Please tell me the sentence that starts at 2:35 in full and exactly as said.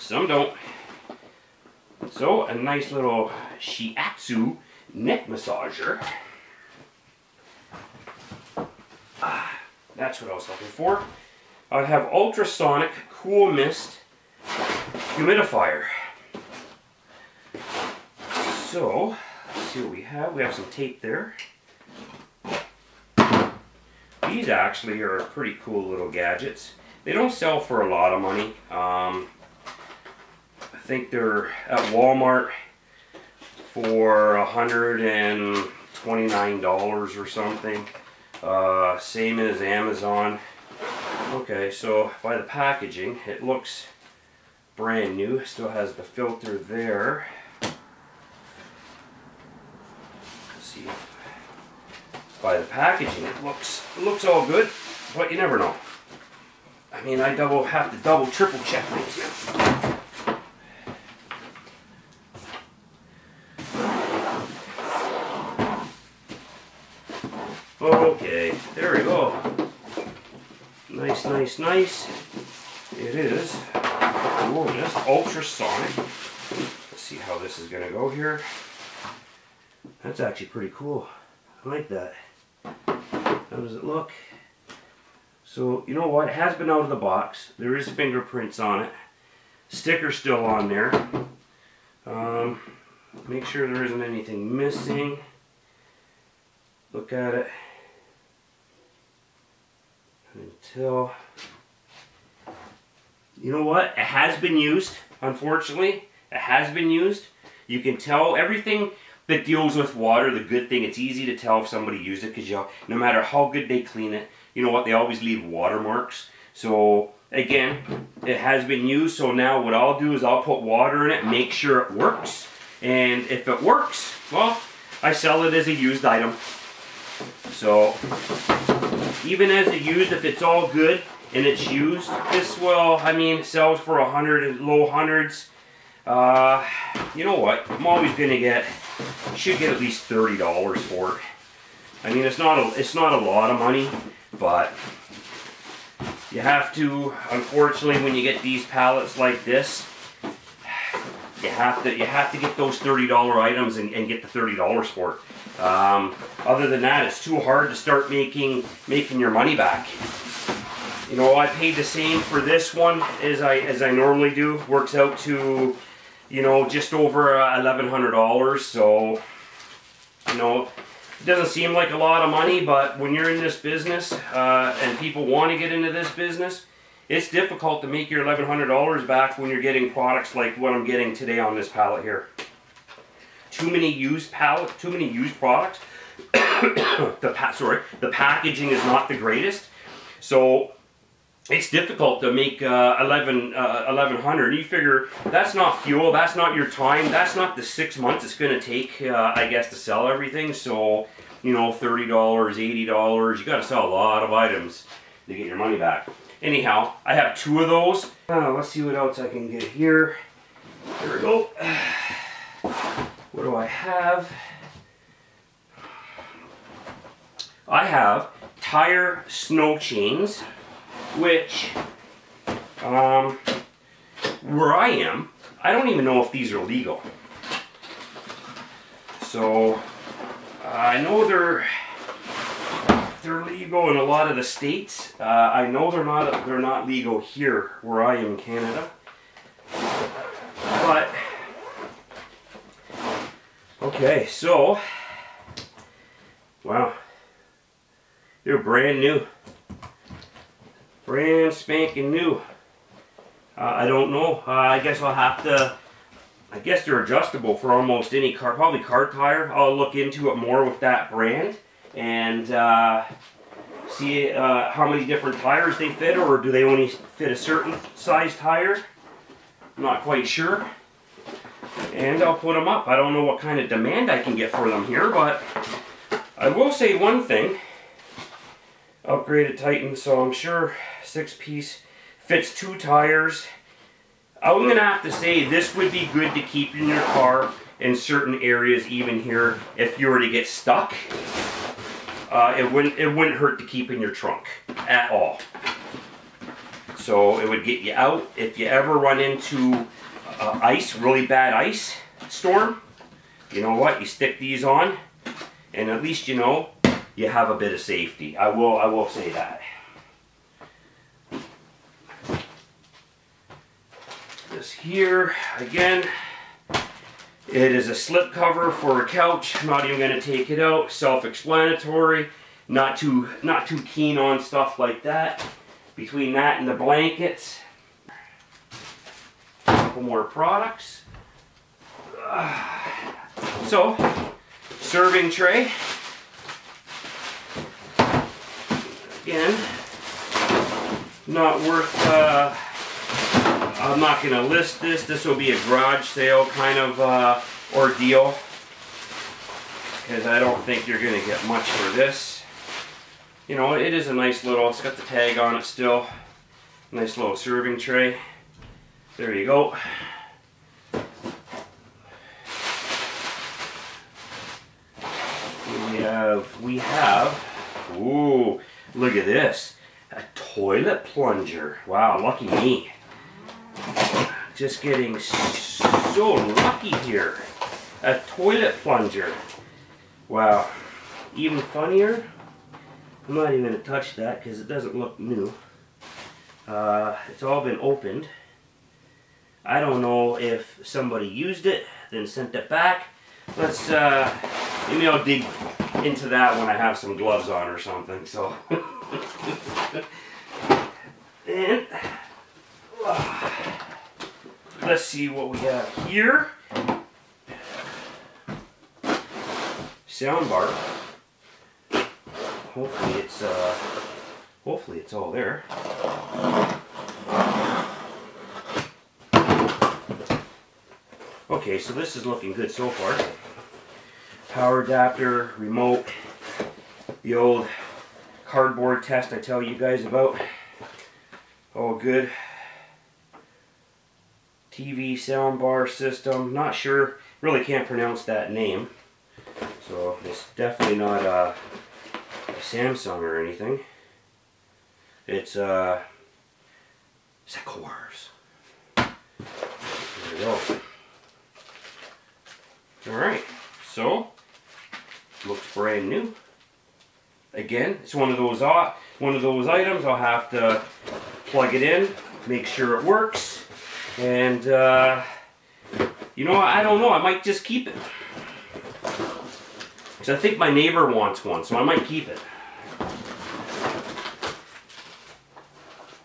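Um, other than that, it's too hard to start making making your money back.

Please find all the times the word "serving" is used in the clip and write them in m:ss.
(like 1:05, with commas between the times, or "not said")
5:34, 5:57.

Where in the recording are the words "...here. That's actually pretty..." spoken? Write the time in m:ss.
1:18.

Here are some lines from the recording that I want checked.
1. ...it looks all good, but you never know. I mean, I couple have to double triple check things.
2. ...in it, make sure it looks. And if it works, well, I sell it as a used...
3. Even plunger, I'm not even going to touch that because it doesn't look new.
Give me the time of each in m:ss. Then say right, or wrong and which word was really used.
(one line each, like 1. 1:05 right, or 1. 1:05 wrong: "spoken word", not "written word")
1. 0:53 wrong: "double", not "couple"
2. 2:01 wrong: "works", not "looks"
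3. 6:21 wrong: "funnier", not "plunger".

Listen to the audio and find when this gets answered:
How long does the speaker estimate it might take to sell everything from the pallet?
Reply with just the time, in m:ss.
3:17.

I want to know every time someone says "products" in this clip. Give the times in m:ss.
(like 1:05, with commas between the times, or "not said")
2:59, 3:05, 5:30.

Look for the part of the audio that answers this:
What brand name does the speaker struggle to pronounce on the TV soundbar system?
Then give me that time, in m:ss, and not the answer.
7:27.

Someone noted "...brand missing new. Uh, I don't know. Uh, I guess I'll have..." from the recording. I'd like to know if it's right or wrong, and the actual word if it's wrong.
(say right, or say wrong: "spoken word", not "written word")
wrong: "spanking", not "missing".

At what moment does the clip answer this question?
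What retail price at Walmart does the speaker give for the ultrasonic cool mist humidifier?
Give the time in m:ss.
0:34.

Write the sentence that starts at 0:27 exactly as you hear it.
They don't sell for a lot of money.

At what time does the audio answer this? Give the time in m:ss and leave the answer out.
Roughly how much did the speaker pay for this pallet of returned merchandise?
2:46.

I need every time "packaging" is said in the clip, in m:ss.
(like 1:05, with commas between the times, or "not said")
0:42, 0:52, 3:08.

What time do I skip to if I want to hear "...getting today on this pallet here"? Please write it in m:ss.
3:00.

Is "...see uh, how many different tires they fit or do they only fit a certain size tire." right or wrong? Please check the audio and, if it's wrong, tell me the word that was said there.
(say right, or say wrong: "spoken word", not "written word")
right.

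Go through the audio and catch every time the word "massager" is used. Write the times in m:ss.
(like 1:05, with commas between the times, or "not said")
0:05.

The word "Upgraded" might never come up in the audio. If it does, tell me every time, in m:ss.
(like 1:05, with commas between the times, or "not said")
4:39.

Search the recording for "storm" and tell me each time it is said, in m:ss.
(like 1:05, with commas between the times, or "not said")
5:02.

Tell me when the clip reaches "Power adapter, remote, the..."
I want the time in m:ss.
7:04.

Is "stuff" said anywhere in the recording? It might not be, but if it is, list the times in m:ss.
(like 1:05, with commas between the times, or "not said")
5:24.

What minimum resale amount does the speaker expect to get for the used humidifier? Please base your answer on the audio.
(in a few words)
$30.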